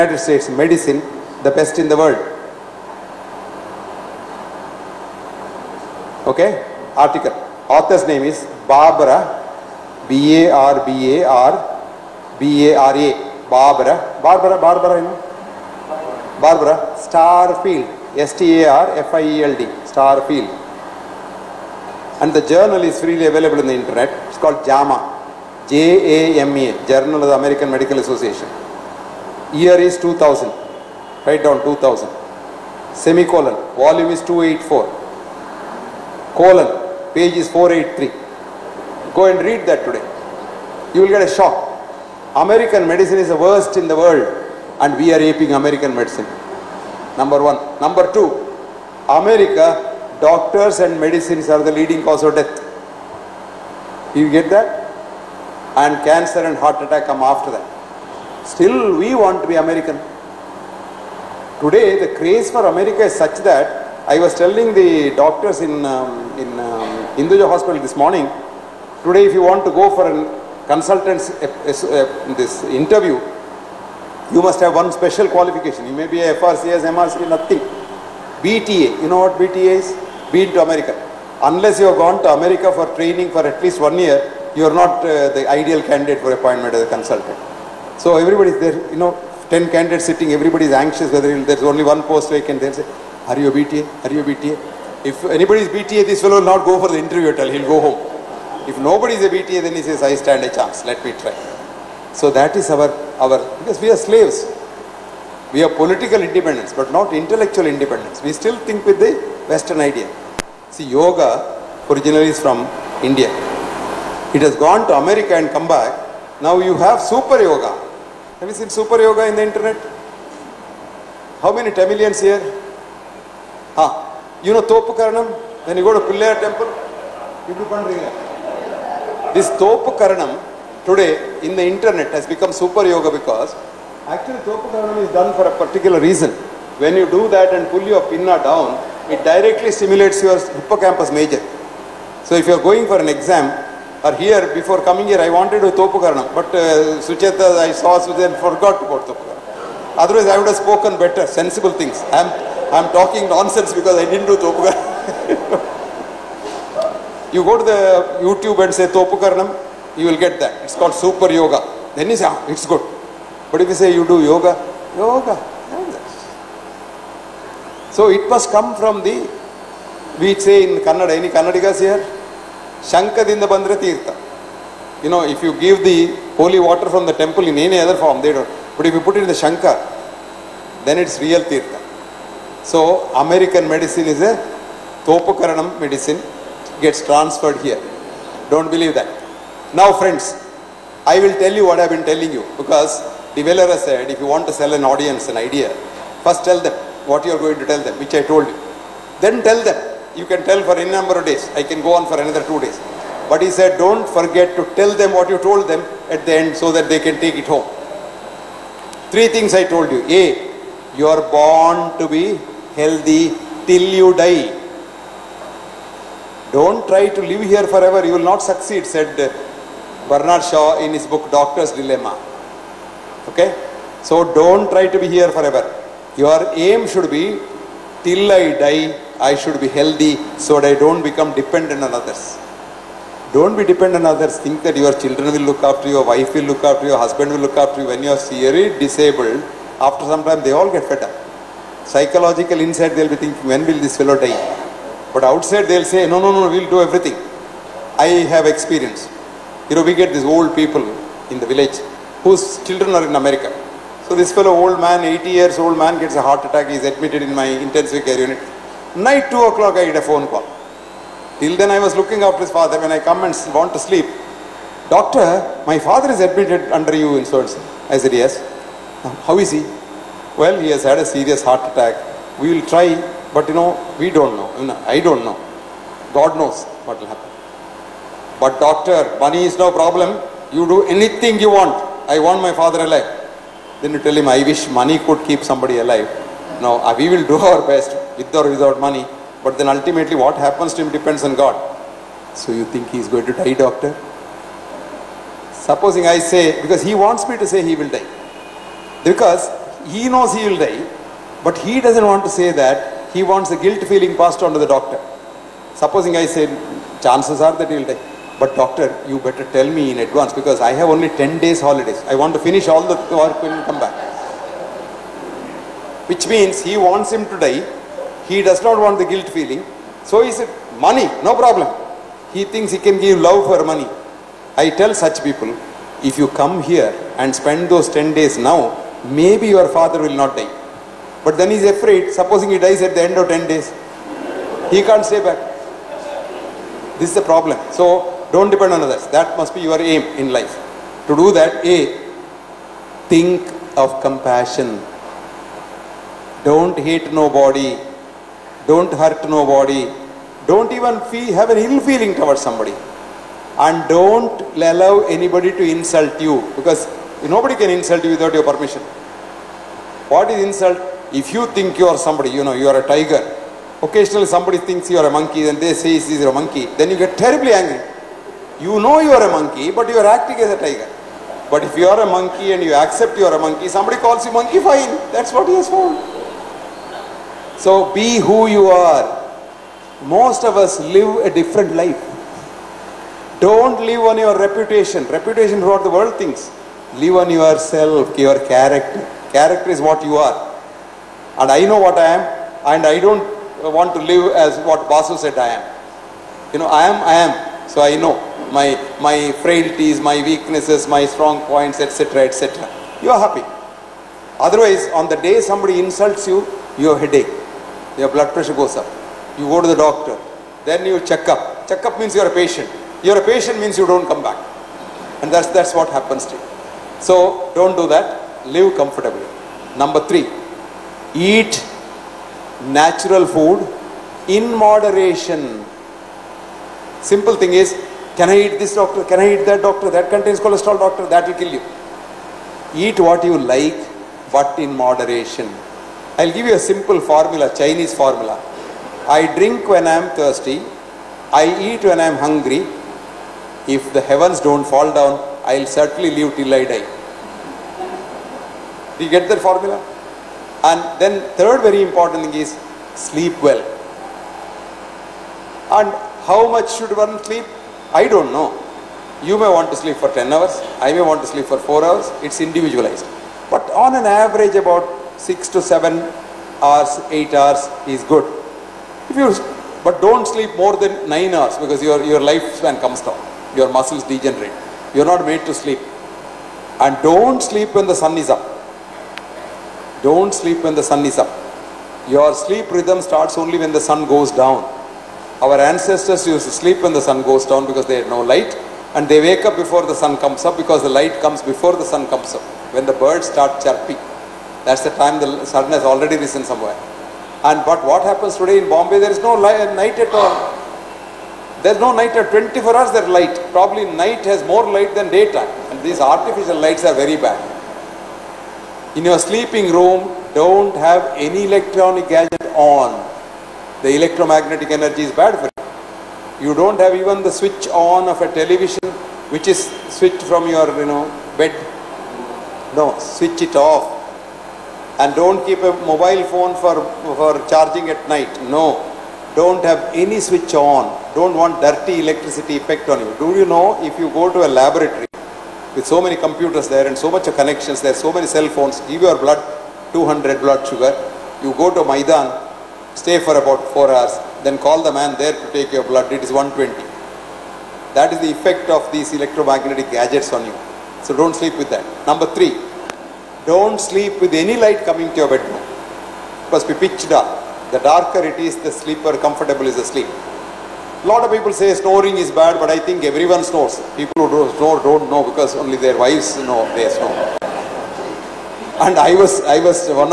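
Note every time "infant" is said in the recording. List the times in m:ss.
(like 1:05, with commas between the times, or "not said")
not said.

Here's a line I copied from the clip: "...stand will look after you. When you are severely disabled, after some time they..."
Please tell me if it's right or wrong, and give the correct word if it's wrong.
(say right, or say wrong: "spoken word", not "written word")
wrong: "husband", not "stand".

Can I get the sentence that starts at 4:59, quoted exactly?
Because he knows he will die, but he doesn't want to say that.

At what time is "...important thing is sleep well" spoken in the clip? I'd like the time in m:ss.
7:31.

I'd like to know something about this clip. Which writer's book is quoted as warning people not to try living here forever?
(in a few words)
Bernard Shaw.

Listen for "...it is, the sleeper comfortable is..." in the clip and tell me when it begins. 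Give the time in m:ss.
9:18.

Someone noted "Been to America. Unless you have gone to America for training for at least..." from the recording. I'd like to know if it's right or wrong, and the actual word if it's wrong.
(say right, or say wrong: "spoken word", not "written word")
right.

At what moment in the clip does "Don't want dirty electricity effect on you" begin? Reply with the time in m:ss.
8:51.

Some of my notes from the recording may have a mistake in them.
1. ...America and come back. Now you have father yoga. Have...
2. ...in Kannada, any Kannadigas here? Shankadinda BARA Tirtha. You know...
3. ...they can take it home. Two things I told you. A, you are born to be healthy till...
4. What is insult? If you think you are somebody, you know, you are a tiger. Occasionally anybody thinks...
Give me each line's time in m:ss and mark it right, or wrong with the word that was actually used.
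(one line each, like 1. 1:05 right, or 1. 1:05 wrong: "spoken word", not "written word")
1. 1:54 wrong: "super", not "father"
2. 2:50 wrong: "Bandra", not "BARA"
3. 3:26 wrong: "Three", not "Two"
4. 6:00 wrong: "somebody", not "anybody".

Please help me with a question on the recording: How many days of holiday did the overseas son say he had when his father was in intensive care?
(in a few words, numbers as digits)
10.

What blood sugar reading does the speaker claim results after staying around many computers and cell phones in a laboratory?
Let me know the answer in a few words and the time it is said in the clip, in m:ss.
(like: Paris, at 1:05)
200, at 8:59.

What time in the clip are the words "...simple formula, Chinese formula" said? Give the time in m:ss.
7:16.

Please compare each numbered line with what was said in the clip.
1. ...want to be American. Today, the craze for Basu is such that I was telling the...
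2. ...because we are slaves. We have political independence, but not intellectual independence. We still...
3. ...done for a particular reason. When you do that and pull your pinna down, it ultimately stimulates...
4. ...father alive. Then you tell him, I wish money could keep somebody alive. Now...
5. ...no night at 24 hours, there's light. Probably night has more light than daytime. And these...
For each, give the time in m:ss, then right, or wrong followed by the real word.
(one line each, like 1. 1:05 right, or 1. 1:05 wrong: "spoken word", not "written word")
1. 0:59 wrong: "America", not "Basu"
2. 1:43 right
3. 2:15 wrong: "directly", not "ultimately"
4. 4:42 right
5. 8:21 right.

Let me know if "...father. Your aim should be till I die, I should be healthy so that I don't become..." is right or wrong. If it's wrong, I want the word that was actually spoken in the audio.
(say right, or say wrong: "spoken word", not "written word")
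wrong: "forever", not "father".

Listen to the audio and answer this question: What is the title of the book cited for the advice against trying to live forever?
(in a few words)
Doctor's Dilemma.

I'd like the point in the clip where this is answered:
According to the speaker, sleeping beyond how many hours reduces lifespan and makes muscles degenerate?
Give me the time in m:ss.
7:51.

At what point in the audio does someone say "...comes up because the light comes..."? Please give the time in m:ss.
8:10.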